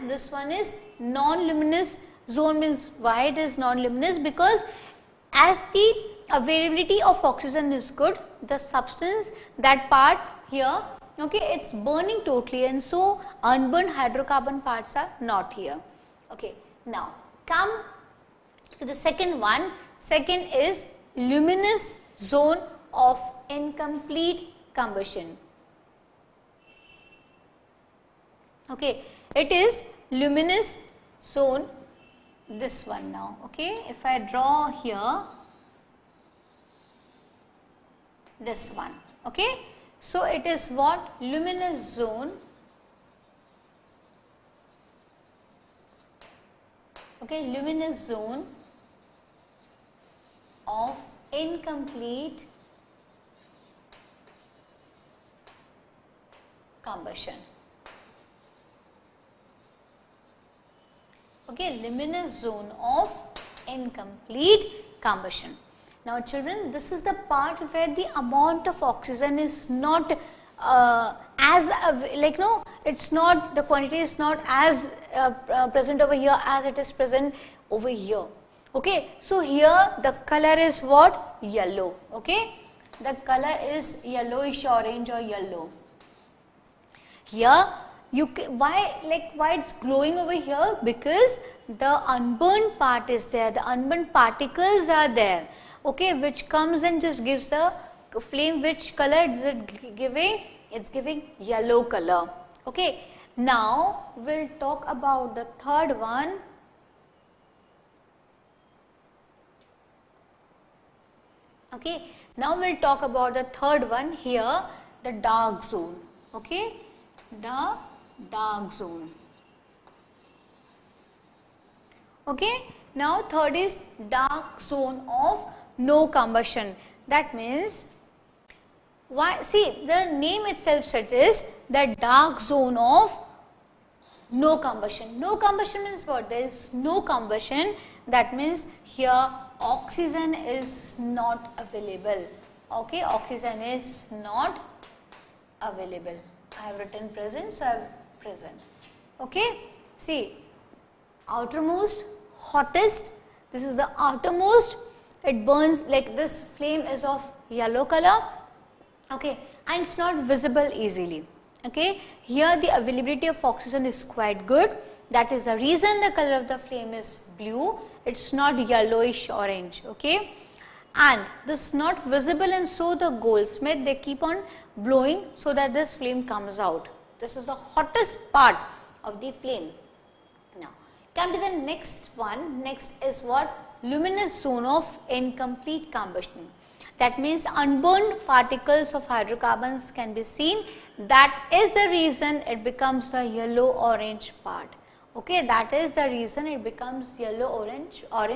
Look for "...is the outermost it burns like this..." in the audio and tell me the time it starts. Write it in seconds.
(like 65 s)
153 s.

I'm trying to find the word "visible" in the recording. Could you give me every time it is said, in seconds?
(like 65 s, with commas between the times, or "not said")
160 s, 172 s.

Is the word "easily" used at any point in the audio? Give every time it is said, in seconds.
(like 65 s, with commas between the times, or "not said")
160 s.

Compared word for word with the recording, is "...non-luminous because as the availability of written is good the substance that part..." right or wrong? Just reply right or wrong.
wrong.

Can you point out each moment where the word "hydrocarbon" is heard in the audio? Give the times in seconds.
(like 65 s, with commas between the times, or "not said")
13 s, 189 s.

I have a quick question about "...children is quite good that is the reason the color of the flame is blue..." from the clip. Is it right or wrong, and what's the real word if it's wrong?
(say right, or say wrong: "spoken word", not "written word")
wrong: "oxygen", not "children".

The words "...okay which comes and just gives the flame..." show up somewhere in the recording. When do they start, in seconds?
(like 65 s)
95 s.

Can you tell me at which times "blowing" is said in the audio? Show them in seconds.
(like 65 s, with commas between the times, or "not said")
174 s.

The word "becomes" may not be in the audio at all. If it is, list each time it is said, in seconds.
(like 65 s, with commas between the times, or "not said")
192 s, 196 s.